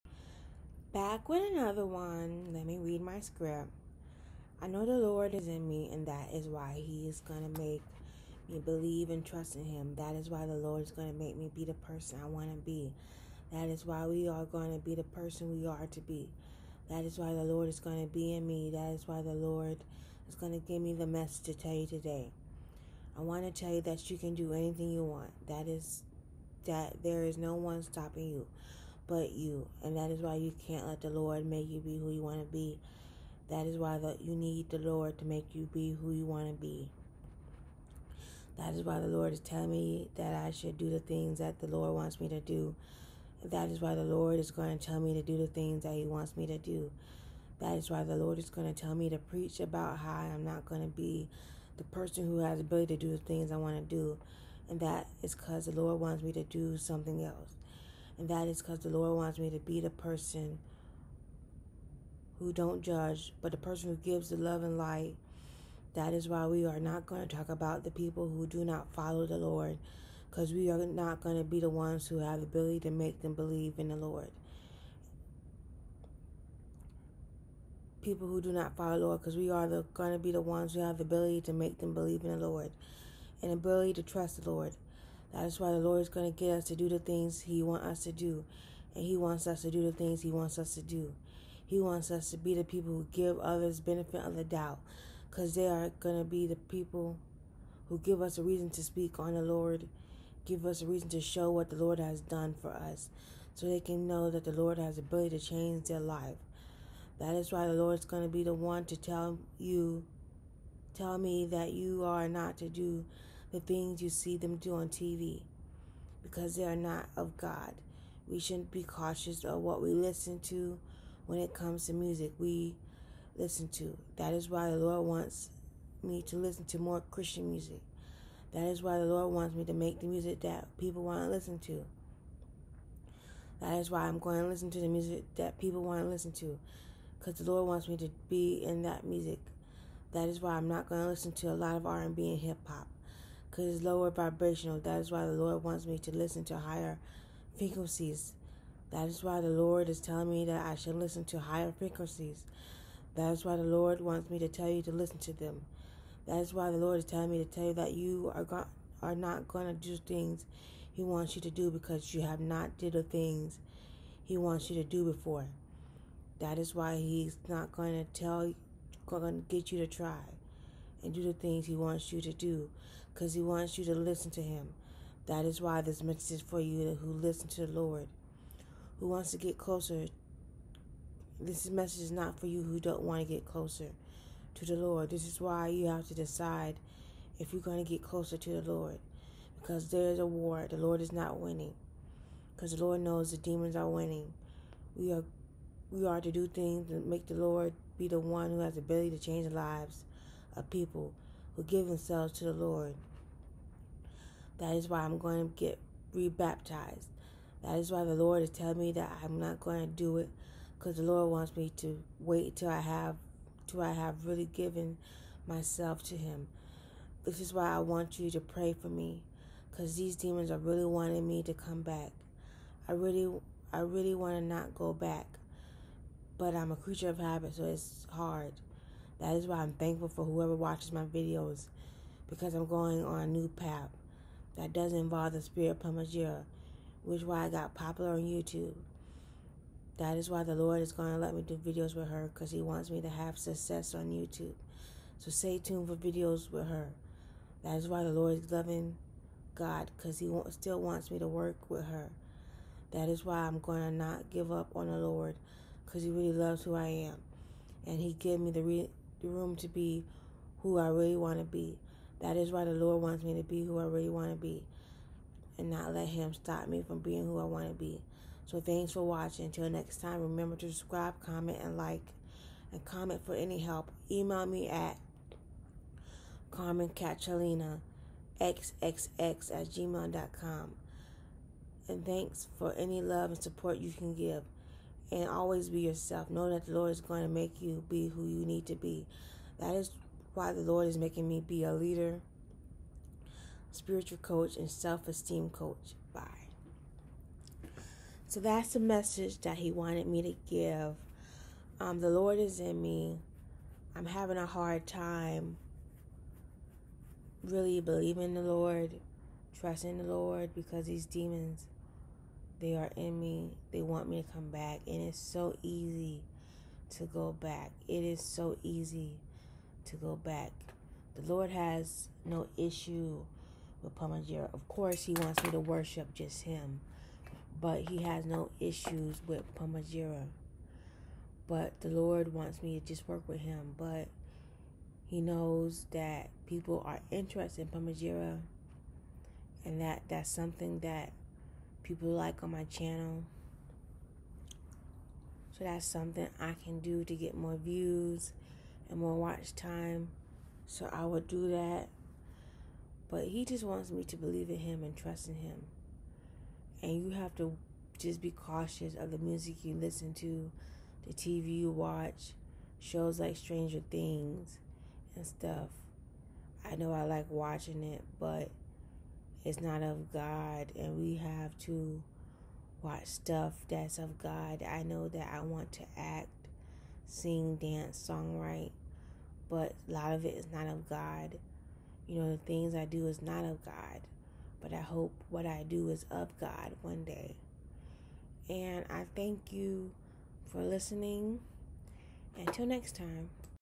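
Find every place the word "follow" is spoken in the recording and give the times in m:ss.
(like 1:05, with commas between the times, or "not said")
1:08, 1:18.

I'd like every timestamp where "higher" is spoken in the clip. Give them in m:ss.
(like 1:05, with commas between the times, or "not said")
2:26, 2:31.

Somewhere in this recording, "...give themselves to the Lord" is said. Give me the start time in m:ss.
3:21.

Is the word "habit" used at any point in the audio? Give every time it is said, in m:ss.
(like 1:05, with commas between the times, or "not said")
3:47.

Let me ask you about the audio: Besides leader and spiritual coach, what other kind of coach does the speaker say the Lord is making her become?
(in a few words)
Self esteem coach.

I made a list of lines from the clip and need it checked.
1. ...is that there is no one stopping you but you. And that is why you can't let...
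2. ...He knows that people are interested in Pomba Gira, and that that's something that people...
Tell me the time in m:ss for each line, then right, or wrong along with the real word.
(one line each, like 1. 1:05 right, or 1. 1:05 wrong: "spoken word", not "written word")
1. 0:25 right
2. 5:35 right.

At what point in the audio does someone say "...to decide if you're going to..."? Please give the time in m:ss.
3:06.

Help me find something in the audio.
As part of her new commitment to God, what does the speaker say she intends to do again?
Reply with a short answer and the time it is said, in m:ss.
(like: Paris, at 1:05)
Rebaptized, at 3:26.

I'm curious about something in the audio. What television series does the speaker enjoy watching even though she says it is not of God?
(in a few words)
Stranger Things.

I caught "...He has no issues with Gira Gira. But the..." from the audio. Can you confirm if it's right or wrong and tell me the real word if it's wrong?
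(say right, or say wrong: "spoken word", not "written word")
wrong: "Pomba", not "Gira".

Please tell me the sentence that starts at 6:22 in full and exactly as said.
You know, the things I do is not of God, but I hope what I do is of God one day.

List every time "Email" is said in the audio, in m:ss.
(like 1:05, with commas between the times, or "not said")
4:34.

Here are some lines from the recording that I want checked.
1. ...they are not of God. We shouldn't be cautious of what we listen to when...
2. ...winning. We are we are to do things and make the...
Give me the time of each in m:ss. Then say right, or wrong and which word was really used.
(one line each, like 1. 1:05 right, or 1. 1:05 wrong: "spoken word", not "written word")
1. 1:56 right
2. 3:13 right.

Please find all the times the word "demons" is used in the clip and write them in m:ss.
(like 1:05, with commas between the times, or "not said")
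3:13, 3:40, 5:11.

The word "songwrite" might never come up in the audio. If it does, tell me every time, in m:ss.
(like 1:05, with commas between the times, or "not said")
6:18.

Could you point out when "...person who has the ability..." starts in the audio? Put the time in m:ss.
0:51.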